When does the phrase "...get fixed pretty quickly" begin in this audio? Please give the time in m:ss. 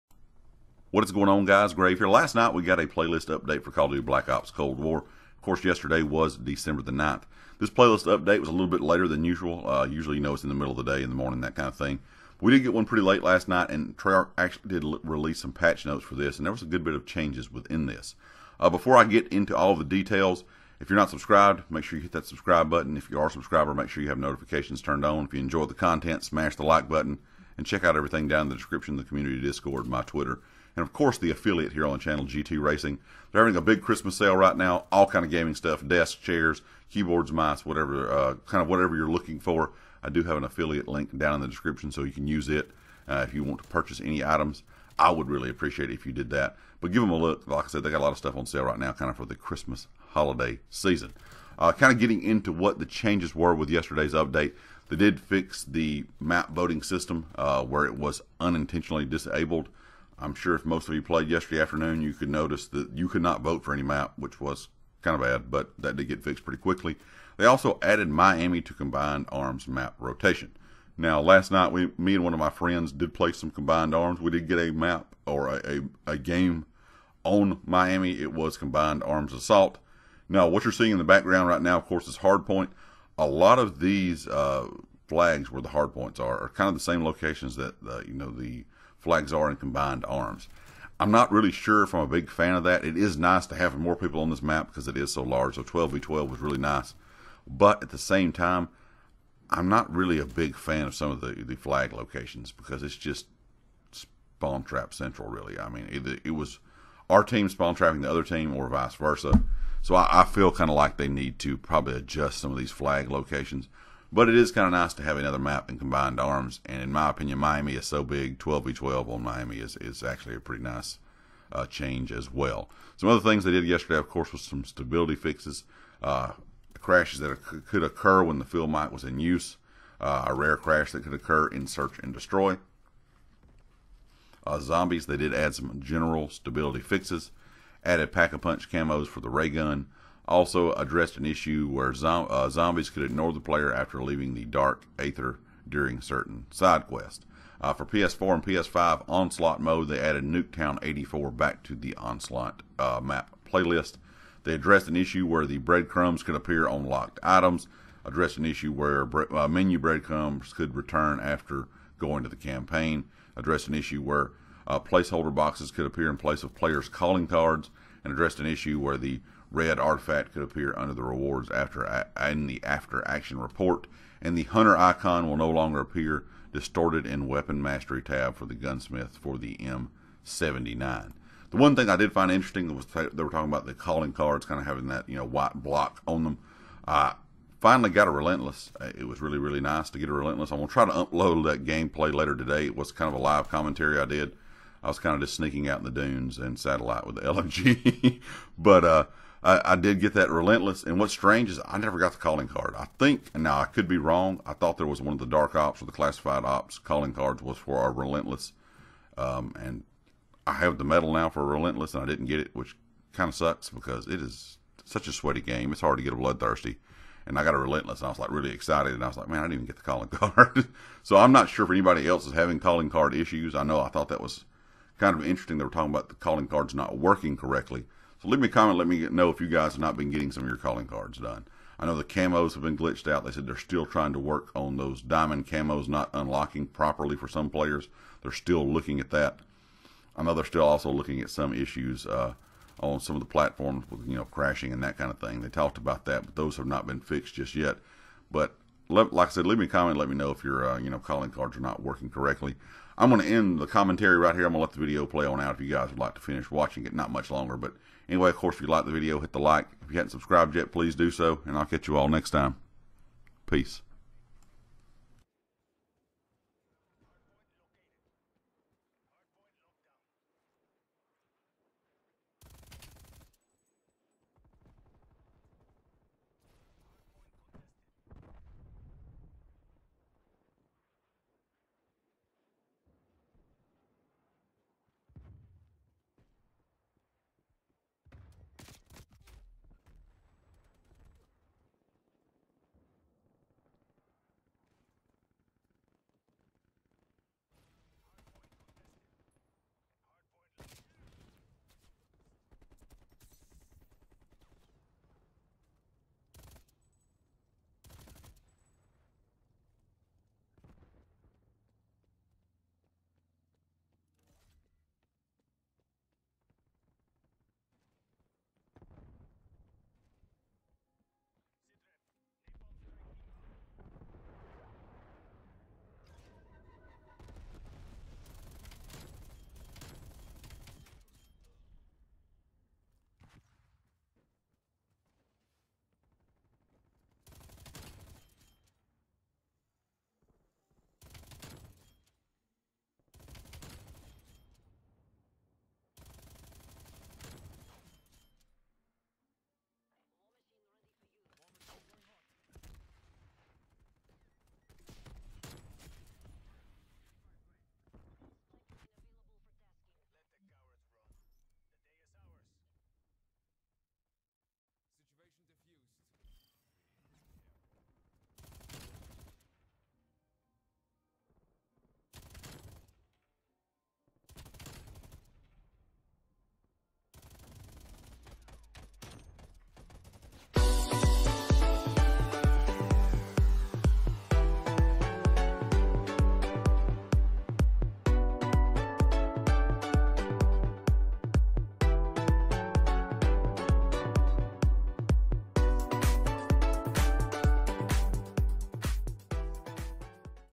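1:06.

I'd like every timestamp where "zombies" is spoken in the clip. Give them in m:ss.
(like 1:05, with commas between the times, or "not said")
2:14, 2:22.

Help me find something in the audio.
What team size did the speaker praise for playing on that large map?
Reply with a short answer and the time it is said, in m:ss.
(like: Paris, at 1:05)
12v12, at 1:35.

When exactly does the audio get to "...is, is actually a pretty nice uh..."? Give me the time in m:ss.
1:59.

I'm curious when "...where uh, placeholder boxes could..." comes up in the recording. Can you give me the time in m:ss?
2:44.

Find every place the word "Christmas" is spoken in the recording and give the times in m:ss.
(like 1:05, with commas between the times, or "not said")
0:33, 0:49.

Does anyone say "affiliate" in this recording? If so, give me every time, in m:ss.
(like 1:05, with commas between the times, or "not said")
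0:31, 0:40.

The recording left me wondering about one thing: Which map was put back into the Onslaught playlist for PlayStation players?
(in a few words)
Nuketown 84.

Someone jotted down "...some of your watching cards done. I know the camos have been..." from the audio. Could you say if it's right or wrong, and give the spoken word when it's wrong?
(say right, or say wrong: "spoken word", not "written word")
wrong: "calling", not "watching".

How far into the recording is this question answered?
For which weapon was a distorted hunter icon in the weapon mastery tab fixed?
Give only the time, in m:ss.
3:00.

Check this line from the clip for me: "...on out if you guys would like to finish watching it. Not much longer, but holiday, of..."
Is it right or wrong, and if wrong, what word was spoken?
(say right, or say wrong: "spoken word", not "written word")
wrong: "anyway", not "holiday".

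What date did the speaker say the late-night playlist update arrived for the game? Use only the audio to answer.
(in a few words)
December 9th.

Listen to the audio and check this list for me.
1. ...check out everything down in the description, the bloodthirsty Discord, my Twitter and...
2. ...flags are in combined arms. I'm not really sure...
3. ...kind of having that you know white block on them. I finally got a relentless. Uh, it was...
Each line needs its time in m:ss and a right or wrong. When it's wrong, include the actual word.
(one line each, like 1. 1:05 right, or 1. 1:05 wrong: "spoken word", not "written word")
1. 0:27 wrong: "community", not "bloodthirsty"
2. 1:29 right
3. 3:04 right.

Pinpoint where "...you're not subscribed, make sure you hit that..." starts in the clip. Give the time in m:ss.
0:20.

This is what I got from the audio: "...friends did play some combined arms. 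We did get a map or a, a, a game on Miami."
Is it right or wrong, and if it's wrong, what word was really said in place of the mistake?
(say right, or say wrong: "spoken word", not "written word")
right.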